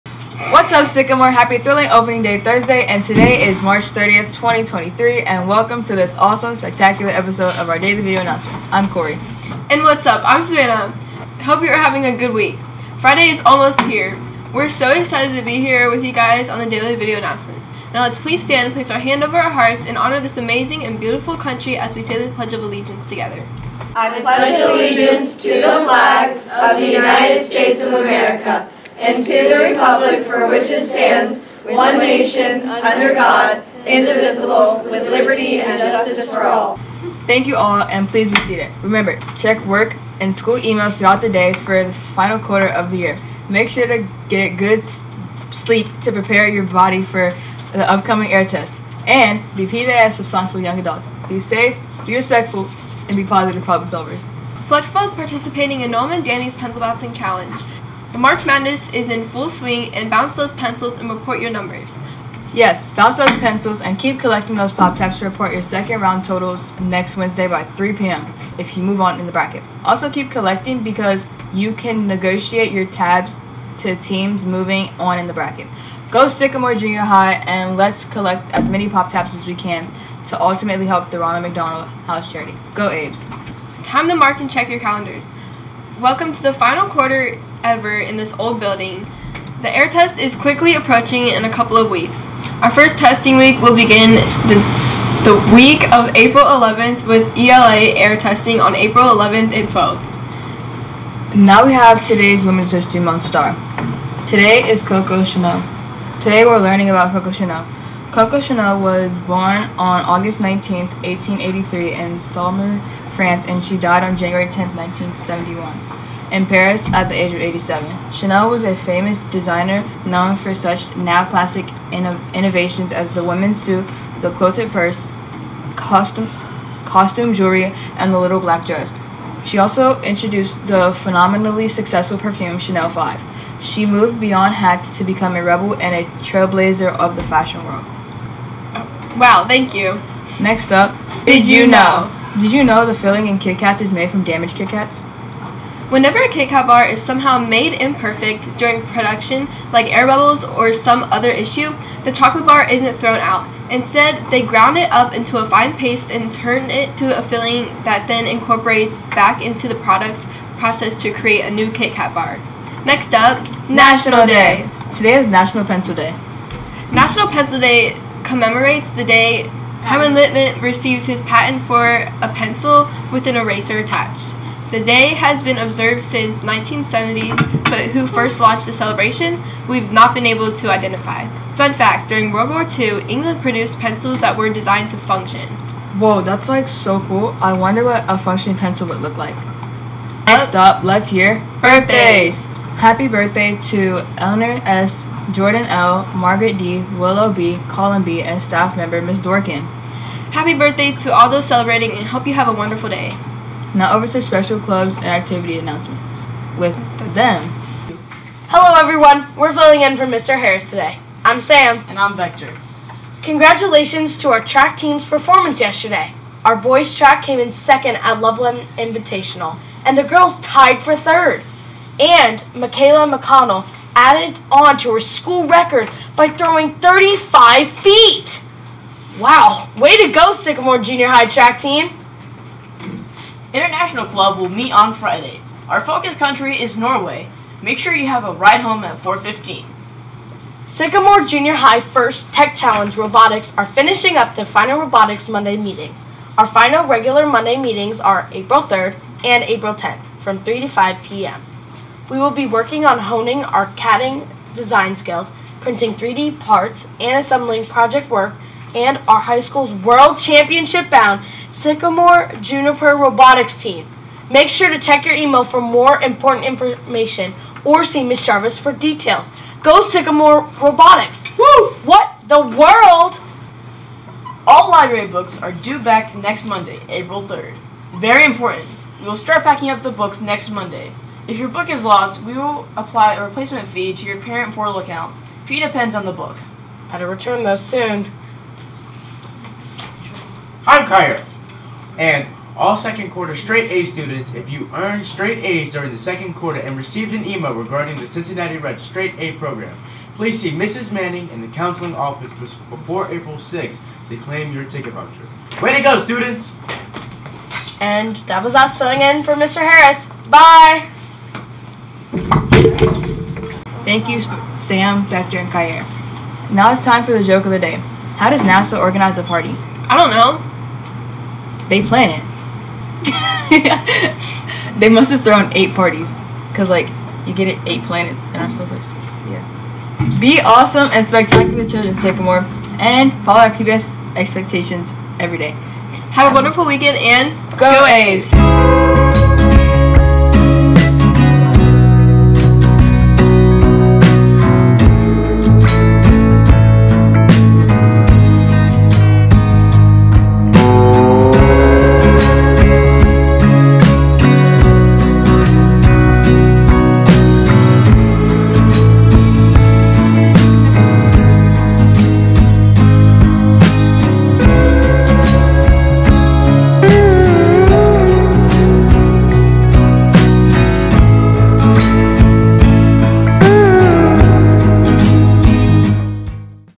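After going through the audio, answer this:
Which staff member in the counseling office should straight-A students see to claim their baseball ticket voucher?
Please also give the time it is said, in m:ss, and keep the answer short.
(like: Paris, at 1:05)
Mrs. Manning, at 5:00.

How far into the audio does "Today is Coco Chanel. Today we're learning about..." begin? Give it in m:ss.
1:44.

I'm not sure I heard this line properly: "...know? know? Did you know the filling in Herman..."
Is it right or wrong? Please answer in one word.
wrong.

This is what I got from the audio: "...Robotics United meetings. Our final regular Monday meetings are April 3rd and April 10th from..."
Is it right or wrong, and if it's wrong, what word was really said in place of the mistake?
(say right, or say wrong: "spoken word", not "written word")
wrong: "Monday", not "United".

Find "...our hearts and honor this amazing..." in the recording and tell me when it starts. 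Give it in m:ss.
0:19.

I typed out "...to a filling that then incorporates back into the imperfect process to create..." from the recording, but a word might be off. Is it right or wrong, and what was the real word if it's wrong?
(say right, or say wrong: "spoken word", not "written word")
wrong: "product", not "imperfect".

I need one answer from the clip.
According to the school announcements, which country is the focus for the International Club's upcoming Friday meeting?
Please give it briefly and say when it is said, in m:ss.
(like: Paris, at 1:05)
Norway, at 3:56.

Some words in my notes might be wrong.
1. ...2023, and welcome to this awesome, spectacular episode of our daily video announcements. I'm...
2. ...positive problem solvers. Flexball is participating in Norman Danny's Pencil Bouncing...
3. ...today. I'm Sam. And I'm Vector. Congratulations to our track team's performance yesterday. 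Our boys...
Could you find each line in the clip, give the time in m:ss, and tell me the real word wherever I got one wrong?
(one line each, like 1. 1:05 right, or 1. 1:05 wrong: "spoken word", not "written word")
1. 0:04 right
2. 0:53 right
3. 3:30 right.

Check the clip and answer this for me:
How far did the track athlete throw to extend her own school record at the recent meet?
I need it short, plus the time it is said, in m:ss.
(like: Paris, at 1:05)
35 feet, at 3:46.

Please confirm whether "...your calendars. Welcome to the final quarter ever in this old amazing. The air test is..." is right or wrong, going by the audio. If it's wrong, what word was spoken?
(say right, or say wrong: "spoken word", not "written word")
wrong: "building", not "amazing".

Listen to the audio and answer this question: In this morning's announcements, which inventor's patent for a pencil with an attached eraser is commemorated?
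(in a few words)
Herman Lipman.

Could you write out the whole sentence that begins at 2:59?
We've not been able to identify.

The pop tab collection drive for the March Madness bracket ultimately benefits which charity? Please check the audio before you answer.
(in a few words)
Ronald McDonald House Charity.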